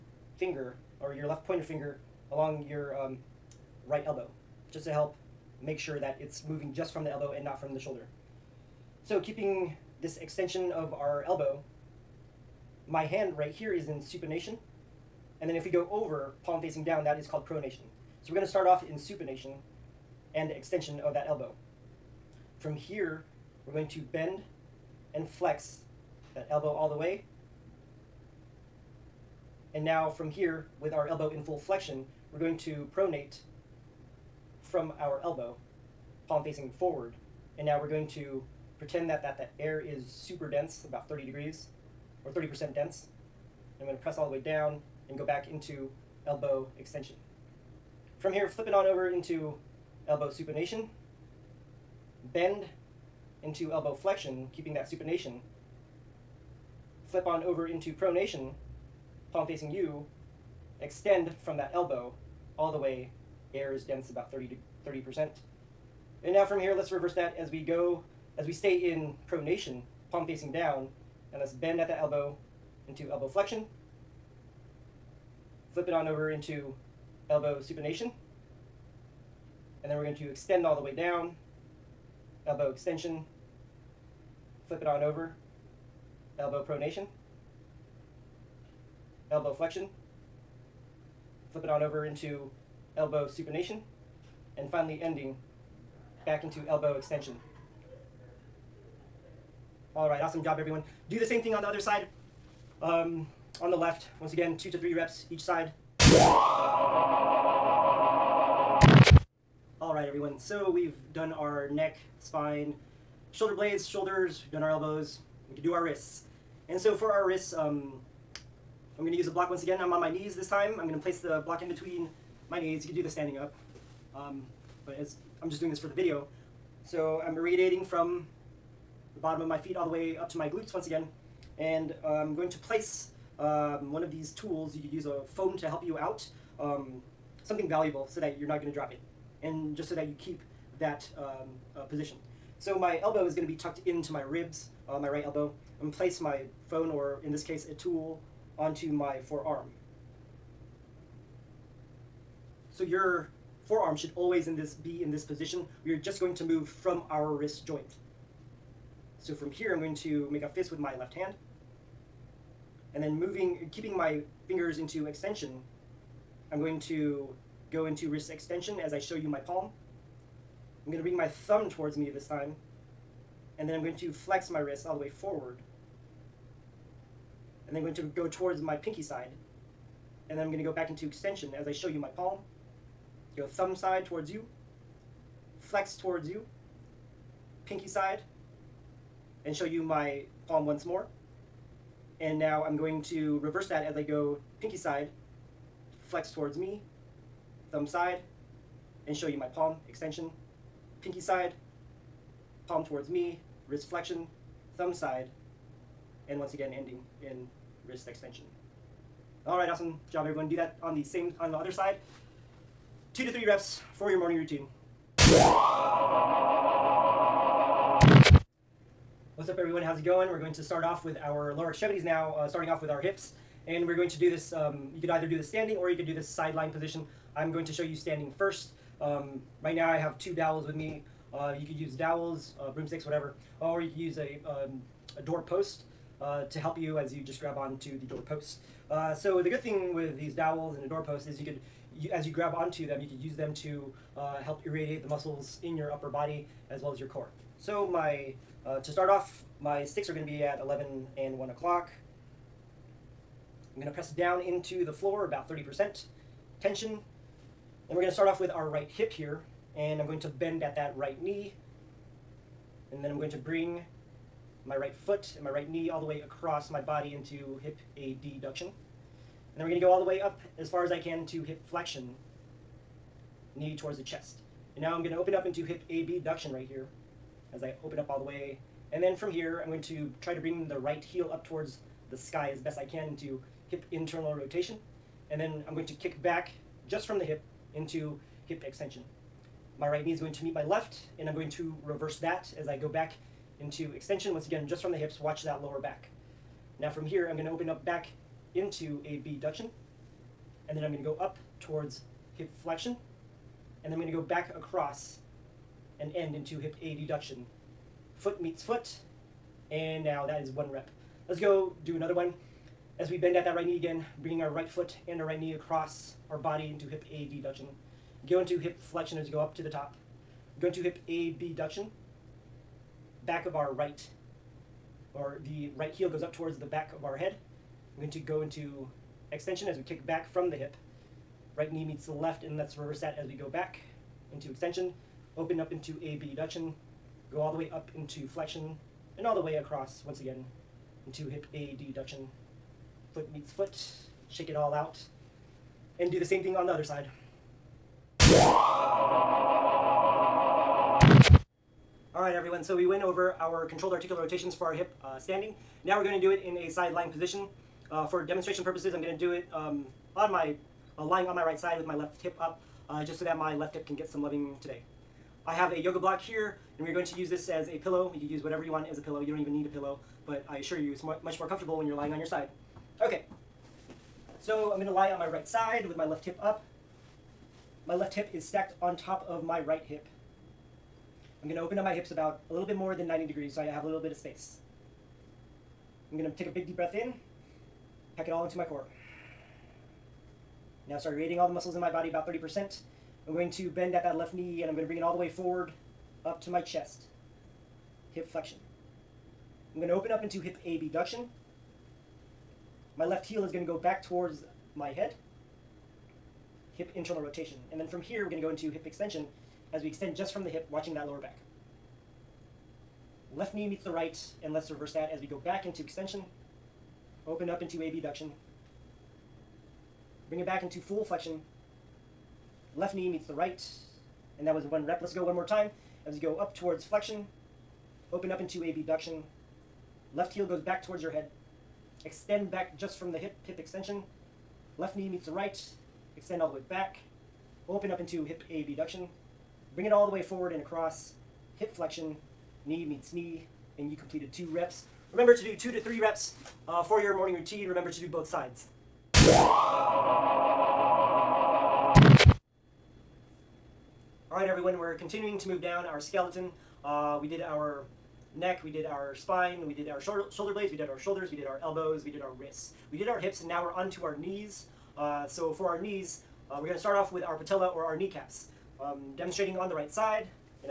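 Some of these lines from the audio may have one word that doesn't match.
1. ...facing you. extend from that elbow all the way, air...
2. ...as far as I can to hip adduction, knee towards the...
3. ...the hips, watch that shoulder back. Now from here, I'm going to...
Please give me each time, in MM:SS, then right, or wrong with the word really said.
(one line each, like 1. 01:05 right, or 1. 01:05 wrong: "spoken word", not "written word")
1. 00:59 right
2. 04:30 wrong: "flexion", not "adduction"
3. 04:54 wrong: "lower", not "shoulder".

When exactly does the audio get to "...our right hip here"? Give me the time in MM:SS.
04:18.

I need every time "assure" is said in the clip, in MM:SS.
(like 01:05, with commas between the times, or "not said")
06:10.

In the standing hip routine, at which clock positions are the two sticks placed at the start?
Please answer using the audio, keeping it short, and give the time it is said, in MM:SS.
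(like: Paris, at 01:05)
11 and 1 o'clock, at 04:10.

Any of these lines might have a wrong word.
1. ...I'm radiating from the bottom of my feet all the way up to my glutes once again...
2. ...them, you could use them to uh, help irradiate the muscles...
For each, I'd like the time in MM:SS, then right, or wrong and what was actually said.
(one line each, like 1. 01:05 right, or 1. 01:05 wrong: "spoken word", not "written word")
1. 02:07 right
2. 04:02 right.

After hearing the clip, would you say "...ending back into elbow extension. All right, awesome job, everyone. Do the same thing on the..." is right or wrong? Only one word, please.
right.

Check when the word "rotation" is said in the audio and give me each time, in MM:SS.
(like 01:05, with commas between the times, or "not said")
04:44, 05:54, 06:47.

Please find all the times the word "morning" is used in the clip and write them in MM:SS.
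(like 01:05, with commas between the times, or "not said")
03:34, 07:27.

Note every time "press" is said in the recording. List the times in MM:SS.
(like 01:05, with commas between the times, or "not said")
00:44, 04:13.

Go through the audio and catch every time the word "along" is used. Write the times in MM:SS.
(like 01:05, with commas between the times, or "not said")
00:02.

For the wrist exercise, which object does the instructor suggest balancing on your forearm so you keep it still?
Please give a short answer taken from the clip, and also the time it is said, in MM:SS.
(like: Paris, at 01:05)
A phone, at 02:15.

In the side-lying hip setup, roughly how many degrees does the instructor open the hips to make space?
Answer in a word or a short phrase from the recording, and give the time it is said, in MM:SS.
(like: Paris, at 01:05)
A little more than 90, at 06:23.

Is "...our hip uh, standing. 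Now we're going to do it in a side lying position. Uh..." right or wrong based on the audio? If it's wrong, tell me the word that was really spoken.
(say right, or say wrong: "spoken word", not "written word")
right.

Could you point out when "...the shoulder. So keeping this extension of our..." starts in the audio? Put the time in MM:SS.
00:07.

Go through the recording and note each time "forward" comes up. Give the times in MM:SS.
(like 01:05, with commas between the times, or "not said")
00:36, 02:55, 06:35, 07:20.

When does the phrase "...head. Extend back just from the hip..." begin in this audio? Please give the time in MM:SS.
07:11.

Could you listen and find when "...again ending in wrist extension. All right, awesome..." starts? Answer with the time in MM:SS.
03:26.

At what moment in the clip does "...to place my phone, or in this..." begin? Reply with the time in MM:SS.
02:25.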